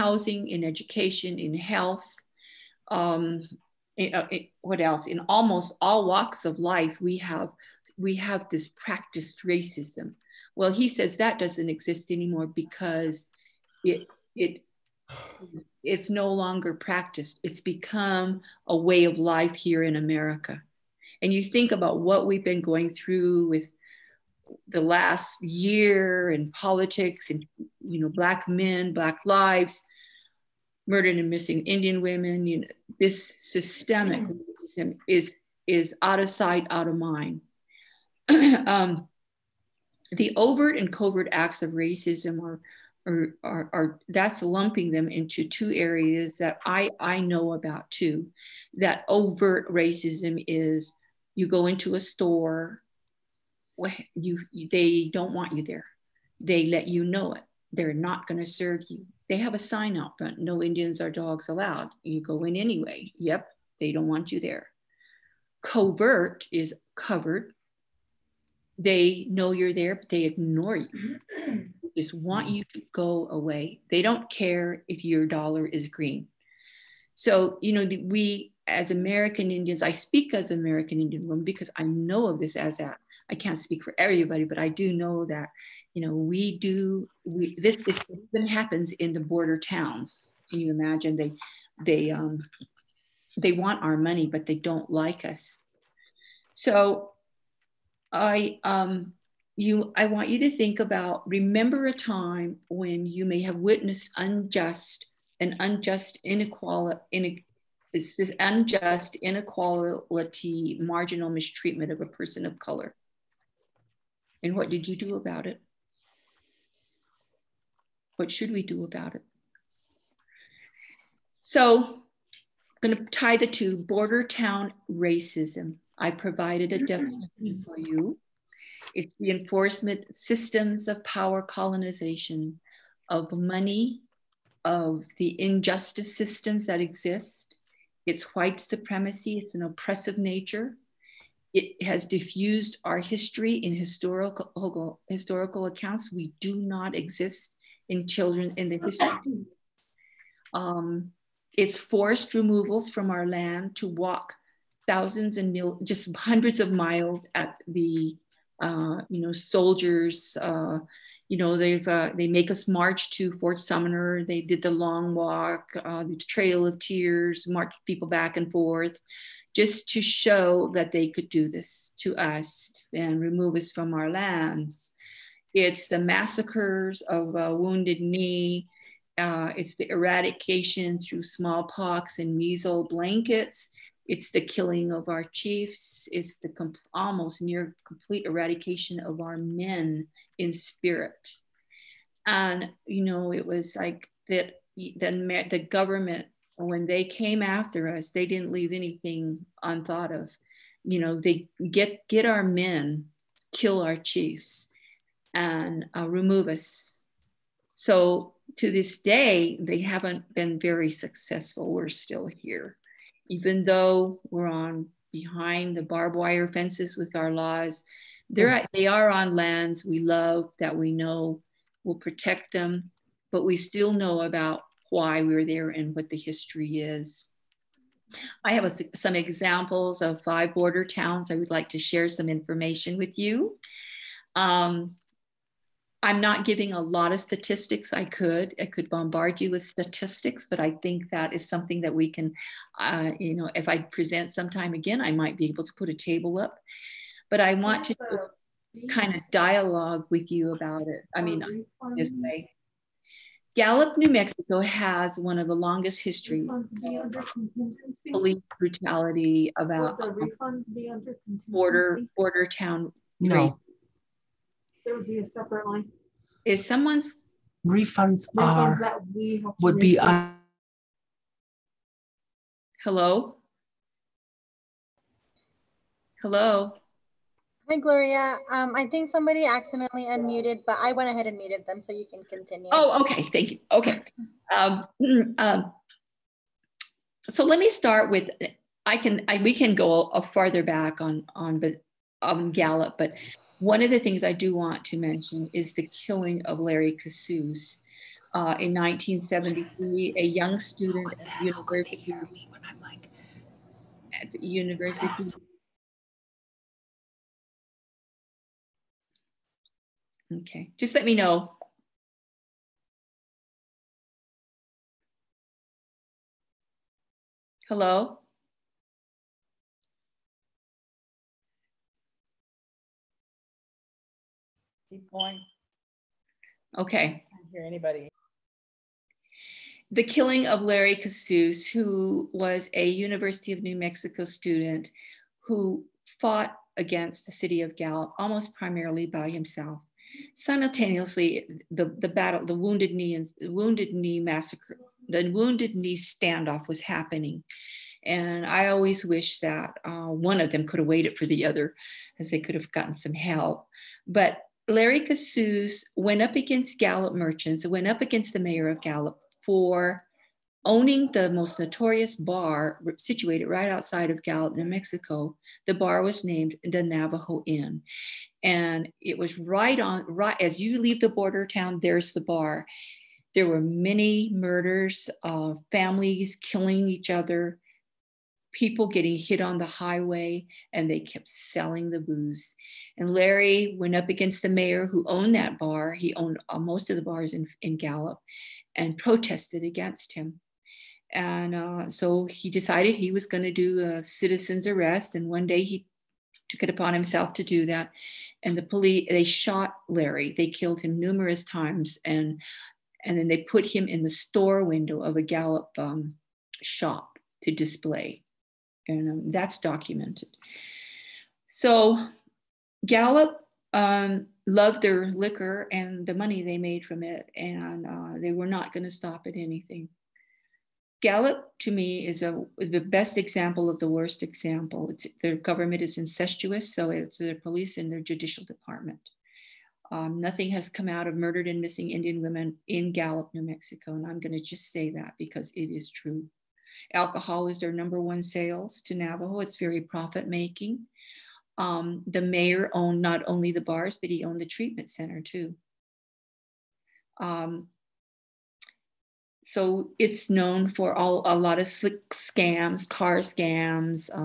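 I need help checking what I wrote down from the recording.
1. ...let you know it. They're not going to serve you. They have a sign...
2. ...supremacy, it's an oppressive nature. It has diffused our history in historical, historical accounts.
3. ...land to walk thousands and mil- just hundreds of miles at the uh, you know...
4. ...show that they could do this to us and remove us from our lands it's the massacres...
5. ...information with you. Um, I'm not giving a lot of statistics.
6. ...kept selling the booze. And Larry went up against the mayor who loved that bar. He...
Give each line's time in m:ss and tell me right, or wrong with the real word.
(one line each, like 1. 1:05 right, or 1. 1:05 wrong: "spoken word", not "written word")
1. 0:56 right
2. 2:18 right
3. 2:33 right
4. 2:50 right
5. 3:52 right
6. 6:20 wrong: "owned", not "loved".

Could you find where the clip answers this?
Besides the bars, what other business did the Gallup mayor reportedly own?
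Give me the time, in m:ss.
7:24.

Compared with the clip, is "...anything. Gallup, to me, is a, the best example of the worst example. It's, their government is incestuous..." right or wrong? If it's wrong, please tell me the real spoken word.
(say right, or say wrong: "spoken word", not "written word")
right.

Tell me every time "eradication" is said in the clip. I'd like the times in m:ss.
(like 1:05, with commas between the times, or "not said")
2:59, 3:08.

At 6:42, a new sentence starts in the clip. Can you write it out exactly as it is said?
And, and then they put him in the store window of a Gallup um, shop to display and um, that's documented.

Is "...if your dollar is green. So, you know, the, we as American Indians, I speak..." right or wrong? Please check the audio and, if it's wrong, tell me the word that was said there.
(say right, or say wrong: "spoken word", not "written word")
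right.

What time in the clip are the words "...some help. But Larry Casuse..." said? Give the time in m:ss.
5:52.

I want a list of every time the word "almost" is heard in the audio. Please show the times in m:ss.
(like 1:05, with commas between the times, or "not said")
0:05, 3:06, 5:38.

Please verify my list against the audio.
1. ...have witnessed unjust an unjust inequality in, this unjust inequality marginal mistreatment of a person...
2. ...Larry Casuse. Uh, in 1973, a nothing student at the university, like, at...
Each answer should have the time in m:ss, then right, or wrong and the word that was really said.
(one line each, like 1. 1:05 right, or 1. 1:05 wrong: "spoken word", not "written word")
1. 1:43 right
2. 4:56 wrong: "young", not "nothing".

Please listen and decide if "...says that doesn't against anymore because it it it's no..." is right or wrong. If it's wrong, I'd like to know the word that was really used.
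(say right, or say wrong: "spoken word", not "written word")
wrong: "exist", not "against".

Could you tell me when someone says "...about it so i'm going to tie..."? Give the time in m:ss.
1:58.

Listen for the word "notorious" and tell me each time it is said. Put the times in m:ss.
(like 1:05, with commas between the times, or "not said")
6:01.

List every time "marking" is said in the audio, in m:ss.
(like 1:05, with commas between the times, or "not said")
not said.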